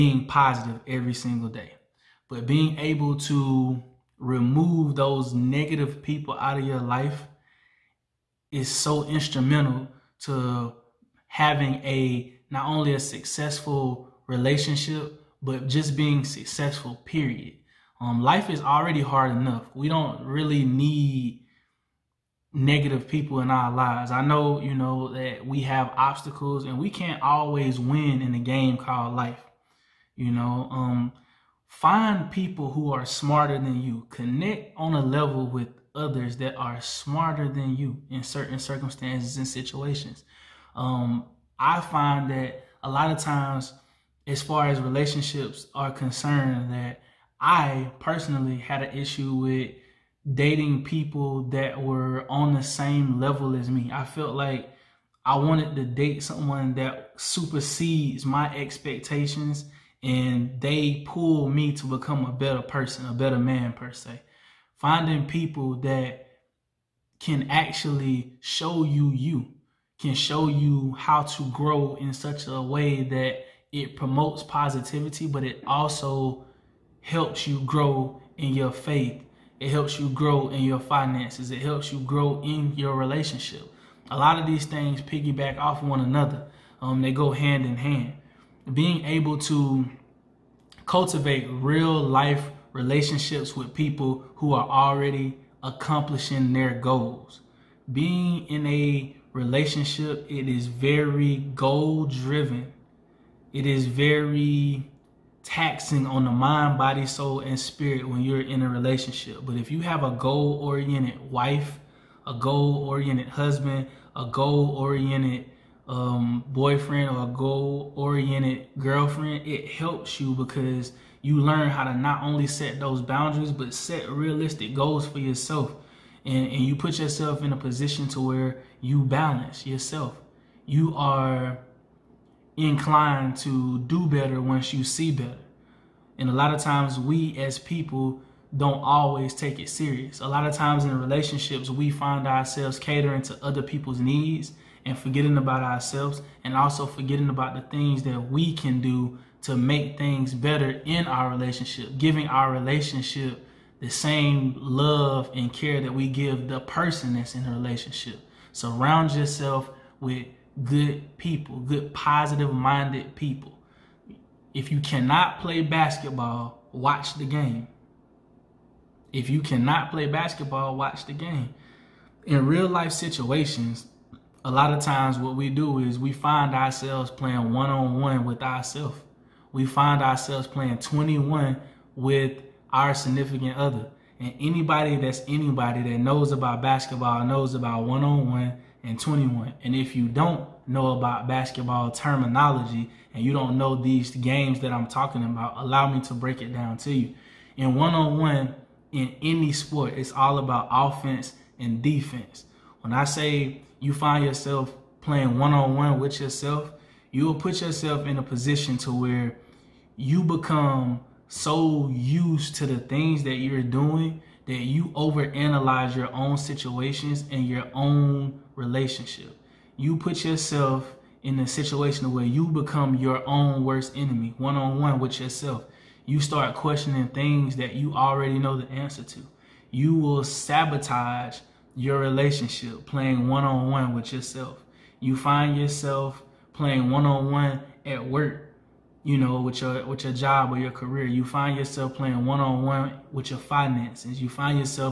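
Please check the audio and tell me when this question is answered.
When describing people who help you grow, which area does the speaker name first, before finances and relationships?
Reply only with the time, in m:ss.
1:18.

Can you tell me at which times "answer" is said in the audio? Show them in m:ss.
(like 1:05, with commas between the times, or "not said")
3:48.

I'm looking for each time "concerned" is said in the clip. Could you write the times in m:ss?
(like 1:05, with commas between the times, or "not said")
0:45.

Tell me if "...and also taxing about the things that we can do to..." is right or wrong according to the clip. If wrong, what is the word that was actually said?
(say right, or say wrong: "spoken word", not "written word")
wrong: "forgetting", not "taxing".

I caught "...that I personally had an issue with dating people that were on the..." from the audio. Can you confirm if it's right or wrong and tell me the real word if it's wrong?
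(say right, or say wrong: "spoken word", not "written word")
right.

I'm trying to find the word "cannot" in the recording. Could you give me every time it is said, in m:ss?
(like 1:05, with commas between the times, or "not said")
2:44, 2:49.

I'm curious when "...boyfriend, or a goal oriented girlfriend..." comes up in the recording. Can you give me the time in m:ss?
1:56.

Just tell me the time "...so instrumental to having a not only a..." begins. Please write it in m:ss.
0:08.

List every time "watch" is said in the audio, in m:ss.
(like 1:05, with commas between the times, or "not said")
2:46, 2:50.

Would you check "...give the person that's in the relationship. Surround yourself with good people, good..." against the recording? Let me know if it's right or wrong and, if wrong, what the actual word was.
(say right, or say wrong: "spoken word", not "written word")
right.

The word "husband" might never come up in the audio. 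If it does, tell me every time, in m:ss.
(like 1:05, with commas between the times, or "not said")
1:53.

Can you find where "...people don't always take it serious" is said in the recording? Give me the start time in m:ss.
2:17.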